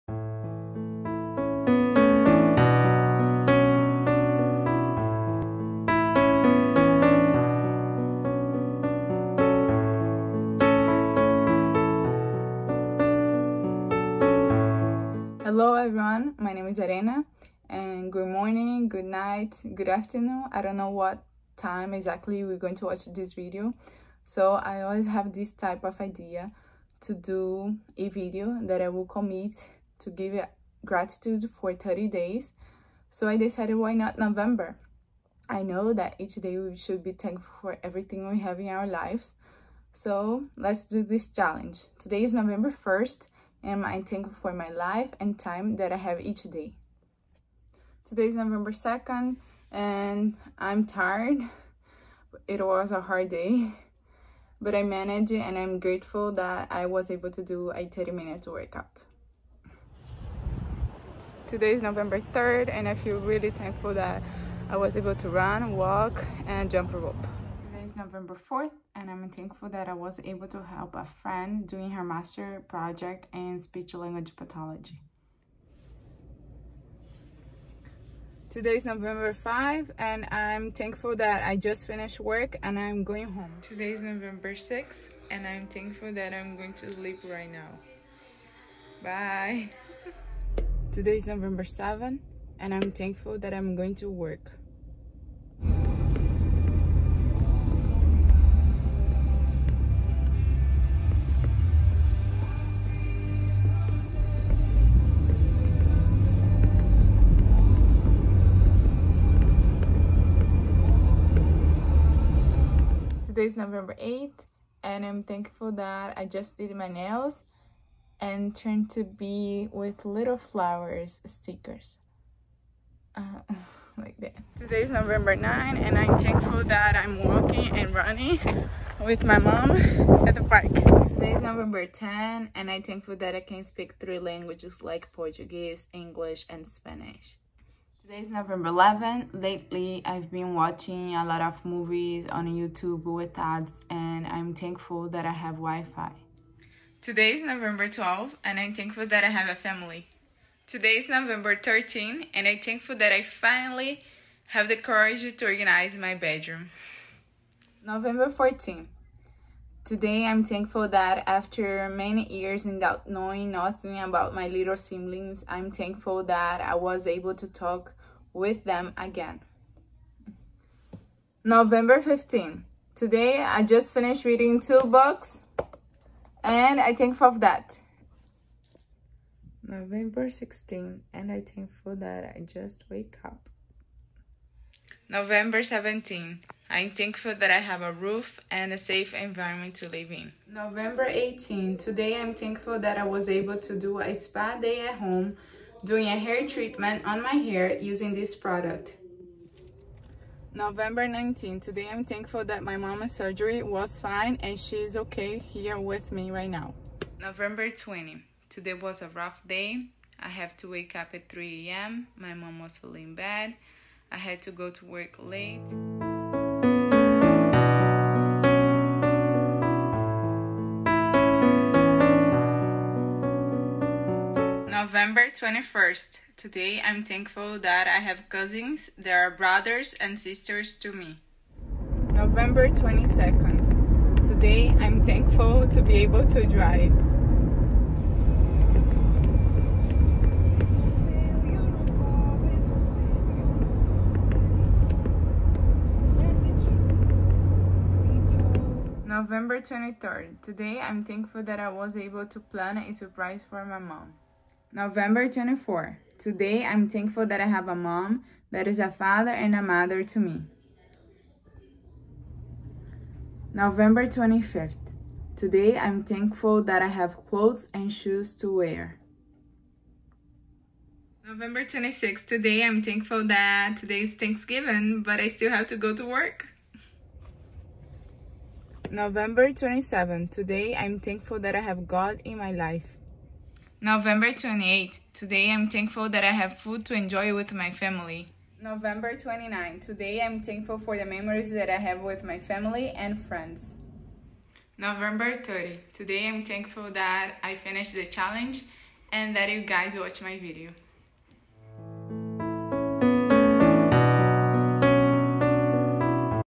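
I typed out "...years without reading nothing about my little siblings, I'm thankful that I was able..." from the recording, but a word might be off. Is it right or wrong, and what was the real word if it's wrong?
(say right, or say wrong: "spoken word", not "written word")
wrong: "knowing", not "reading".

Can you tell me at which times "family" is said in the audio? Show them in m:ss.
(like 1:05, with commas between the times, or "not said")
2:29, 4:47, 4:52.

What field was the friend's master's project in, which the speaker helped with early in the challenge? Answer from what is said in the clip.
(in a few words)
Speech language pathology.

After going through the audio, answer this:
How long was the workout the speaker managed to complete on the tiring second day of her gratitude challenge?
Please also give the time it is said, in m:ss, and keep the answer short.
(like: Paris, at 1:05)
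30 minutes, at 0:57.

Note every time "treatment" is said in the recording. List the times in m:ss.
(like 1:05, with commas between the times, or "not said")
3:16.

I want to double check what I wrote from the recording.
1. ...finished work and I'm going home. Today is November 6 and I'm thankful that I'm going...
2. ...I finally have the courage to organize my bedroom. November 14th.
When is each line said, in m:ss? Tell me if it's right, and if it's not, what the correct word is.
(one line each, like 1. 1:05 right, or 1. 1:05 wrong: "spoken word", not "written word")
1. 1:21 right
2. 2:33 right.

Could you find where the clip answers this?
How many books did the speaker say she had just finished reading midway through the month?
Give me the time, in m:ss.
2:54.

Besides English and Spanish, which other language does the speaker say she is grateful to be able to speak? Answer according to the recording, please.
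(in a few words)
Portuguese.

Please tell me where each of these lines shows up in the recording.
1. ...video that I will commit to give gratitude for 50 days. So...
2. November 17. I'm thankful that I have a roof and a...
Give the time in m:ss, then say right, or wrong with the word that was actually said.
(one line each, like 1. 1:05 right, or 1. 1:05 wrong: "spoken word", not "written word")
1. 0:28 wrong: "30", not "50"
2. 3:05 right.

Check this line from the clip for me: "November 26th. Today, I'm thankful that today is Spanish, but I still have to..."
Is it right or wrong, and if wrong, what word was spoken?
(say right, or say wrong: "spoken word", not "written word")
wrong: "Thanksgiving", not "Spanish".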